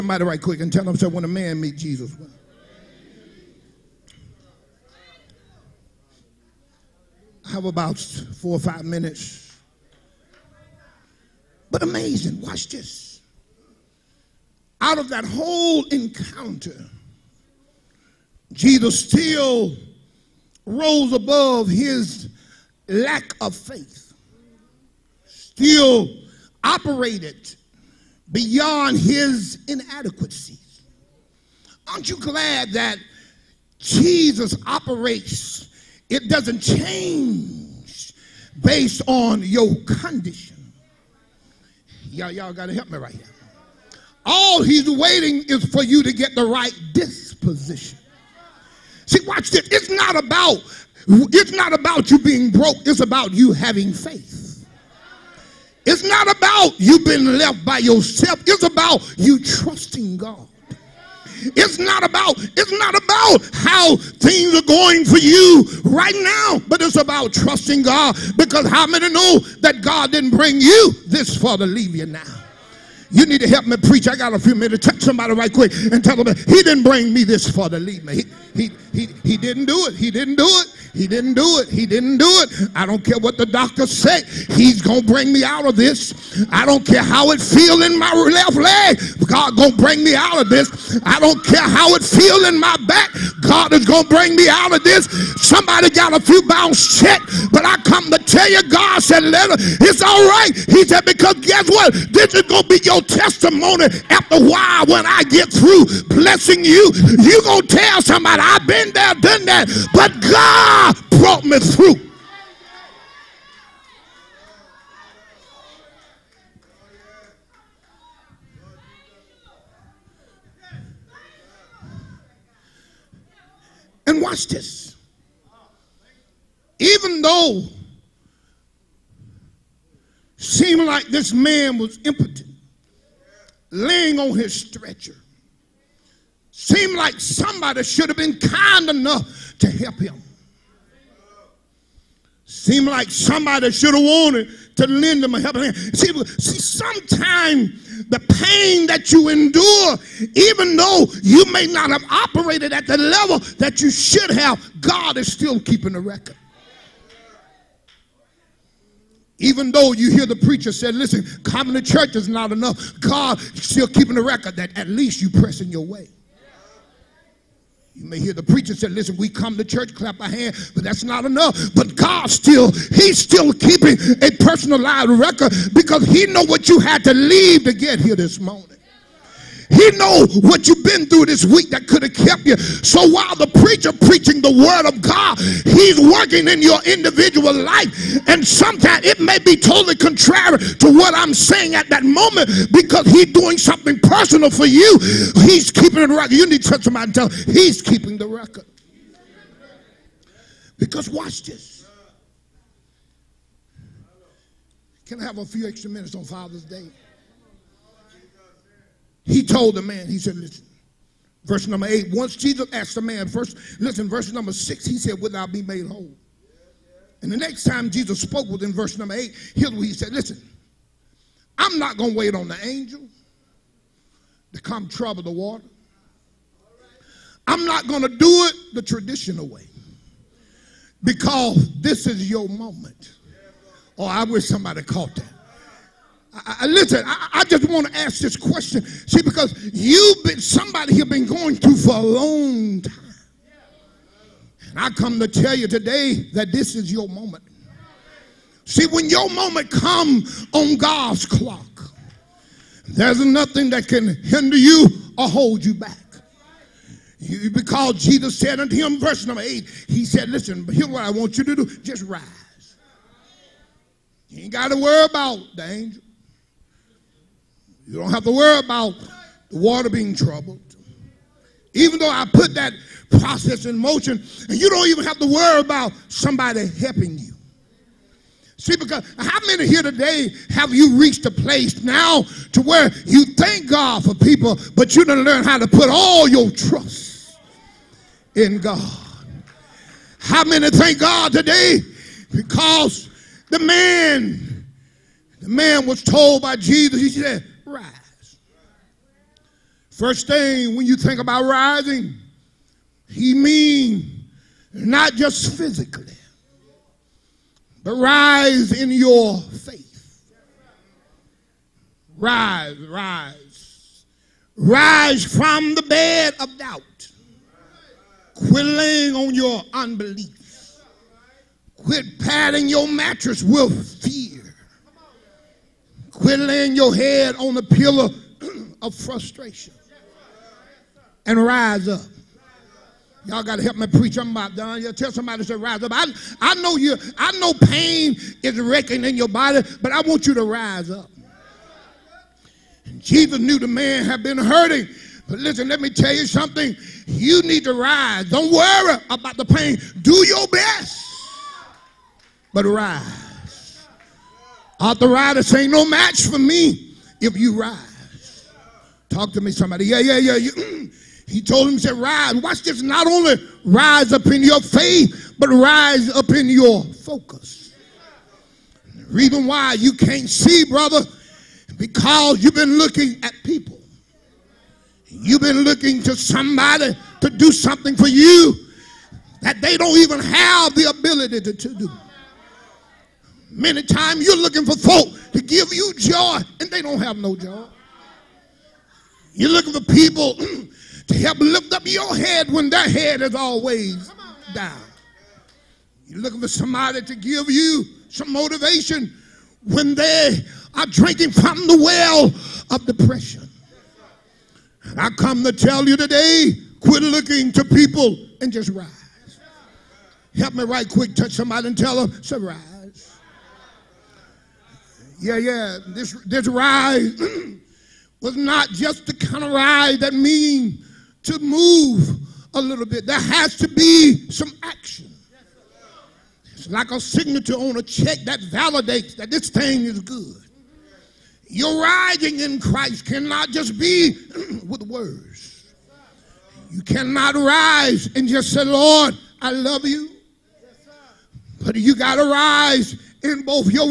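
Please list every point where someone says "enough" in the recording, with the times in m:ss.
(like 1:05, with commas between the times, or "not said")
2:18, 2:42, 2:51.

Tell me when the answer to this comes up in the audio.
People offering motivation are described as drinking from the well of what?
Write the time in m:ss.
6:42.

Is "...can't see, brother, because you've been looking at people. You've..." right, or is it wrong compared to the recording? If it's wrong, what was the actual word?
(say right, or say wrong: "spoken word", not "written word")
right.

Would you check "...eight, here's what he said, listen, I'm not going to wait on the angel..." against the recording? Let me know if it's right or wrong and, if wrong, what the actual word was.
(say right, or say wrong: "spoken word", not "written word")
right.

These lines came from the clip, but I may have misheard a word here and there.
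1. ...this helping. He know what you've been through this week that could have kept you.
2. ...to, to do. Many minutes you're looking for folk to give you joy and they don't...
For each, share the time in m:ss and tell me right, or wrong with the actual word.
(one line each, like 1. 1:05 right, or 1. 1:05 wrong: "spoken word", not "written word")
1. 2:58 wrong: "morning", not "helping"
2. 6:21 wrong: "times", not "minutes".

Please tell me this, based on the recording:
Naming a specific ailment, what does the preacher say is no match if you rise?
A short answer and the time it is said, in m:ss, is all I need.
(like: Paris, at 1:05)
Arthritis, at 5:54.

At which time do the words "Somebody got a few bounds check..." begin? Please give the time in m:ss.
1:35.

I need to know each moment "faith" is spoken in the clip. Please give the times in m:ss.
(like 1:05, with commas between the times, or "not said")
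0:23, 0:53, 5:09, 6:04.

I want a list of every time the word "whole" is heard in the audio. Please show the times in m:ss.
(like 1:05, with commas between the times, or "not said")
0:15, 3:35.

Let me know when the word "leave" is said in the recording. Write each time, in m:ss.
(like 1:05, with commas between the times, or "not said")
1:11, 2:57.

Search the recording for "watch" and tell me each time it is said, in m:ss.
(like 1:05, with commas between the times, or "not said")
0:12, 0:49, 2:04, 3:21, 6:02.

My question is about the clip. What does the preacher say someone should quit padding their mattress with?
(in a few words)
fear.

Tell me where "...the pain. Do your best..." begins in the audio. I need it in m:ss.
5:49.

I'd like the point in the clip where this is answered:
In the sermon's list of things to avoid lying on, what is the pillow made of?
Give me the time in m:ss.
5:28.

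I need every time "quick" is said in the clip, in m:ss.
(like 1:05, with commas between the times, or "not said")
0:00, 1:15, 6:50.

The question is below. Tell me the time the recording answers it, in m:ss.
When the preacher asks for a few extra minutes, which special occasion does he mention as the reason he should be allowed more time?
3:26.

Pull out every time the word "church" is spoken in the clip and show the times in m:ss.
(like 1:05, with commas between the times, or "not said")
2:41, 2:49.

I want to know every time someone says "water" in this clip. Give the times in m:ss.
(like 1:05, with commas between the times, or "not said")
3:45, 4:29.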